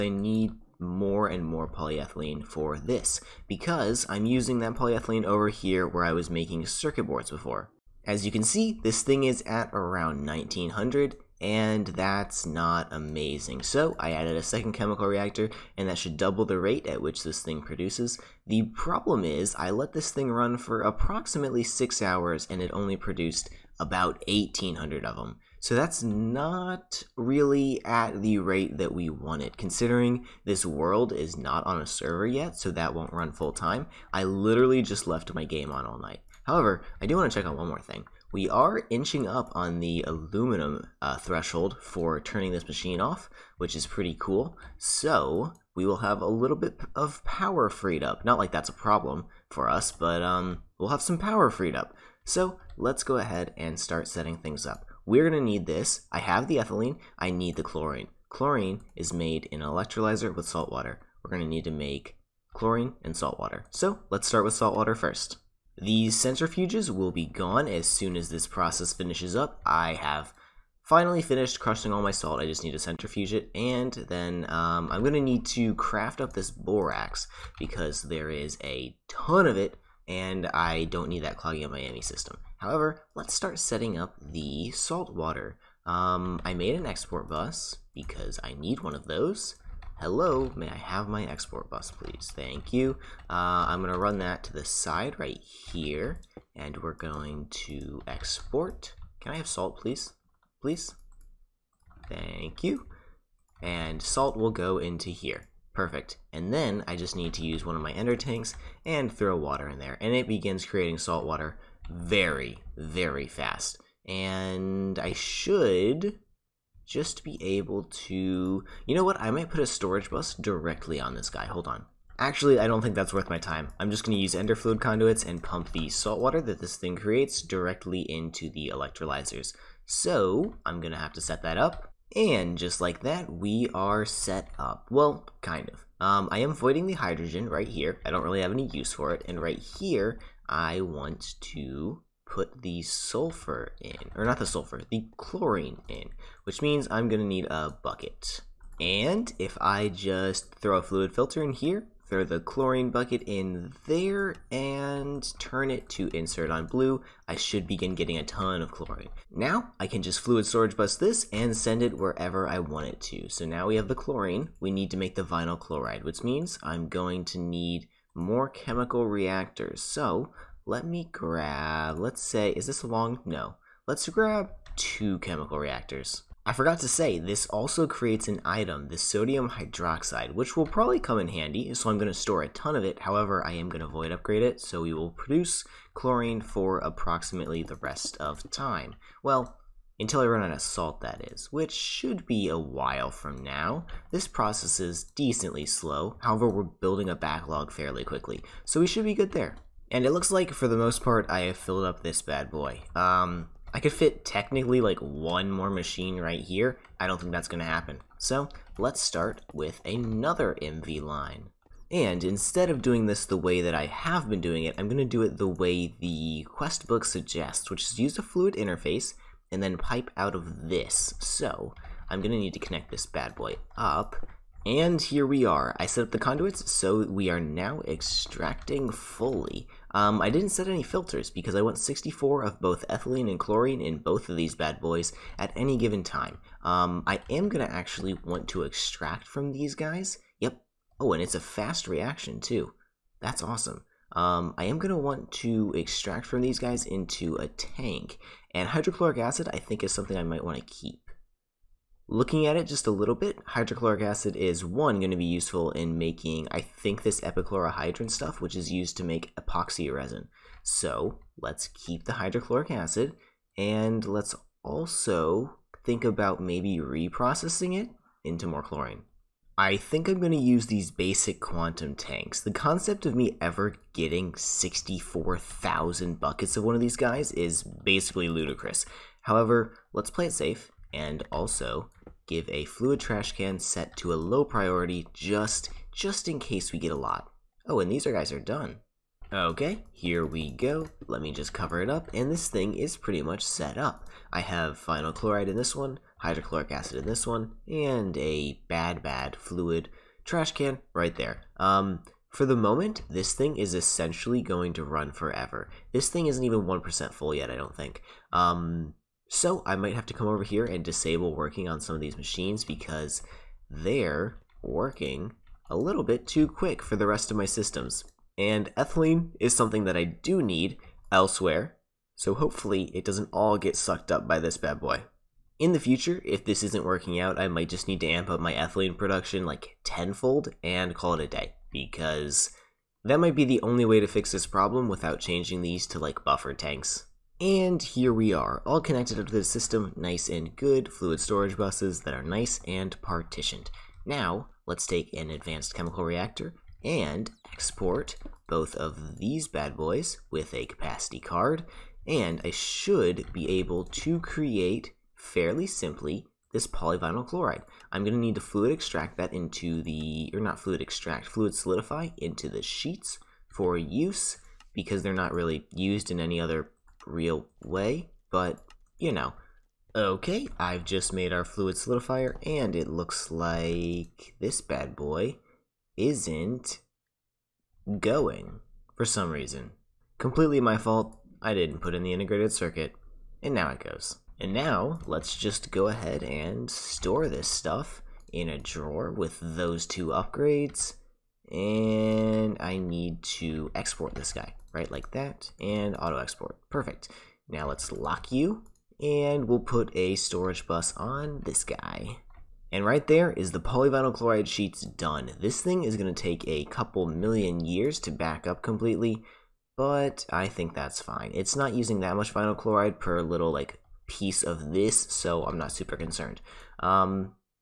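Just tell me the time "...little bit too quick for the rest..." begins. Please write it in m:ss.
5:15.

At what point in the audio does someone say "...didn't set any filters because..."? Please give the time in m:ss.
3:50.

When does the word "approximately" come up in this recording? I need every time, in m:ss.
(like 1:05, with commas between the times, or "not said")
0:20, 3:06.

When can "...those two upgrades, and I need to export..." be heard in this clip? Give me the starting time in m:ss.
6:29.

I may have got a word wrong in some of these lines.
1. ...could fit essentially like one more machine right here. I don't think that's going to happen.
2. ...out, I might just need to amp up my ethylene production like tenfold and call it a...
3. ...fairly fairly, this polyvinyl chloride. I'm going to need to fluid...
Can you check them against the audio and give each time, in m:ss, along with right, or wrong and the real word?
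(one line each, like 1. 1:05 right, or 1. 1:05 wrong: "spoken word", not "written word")
1. 3:23 wrong: "technically", not "essentially"
2. 5:27 right
3. 5:55 wrong: "simply", not "fairly".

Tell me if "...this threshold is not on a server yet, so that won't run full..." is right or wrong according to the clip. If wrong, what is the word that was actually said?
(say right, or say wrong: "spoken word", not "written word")
wrong: "world", not "threshold".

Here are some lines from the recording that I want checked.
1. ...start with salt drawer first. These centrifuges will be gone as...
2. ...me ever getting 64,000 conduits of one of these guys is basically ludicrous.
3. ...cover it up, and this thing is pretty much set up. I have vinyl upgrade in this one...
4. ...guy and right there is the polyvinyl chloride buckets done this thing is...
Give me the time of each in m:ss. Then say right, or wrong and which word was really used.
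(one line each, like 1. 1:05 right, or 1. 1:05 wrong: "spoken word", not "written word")
1. 1:04 wrong: "water", not "drawer"
2. 4:33 wrong: "buckets", not "conduits"
3. 4:51 wrong: "chloride", not "upgrade"
4. 6:41 wrong: "sheets", not "buckets".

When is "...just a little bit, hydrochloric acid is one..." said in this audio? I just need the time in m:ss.
4:12.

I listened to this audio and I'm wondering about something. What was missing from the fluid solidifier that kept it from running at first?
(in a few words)
integrated circuit.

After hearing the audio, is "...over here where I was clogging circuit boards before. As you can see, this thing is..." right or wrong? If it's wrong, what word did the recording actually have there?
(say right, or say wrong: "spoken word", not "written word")
wrong: "making", not "clogging".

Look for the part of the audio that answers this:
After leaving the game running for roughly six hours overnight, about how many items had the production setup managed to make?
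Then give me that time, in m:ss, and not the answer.
0:24.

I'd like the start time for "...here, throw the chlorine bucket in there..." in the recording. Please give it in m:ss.
2:31.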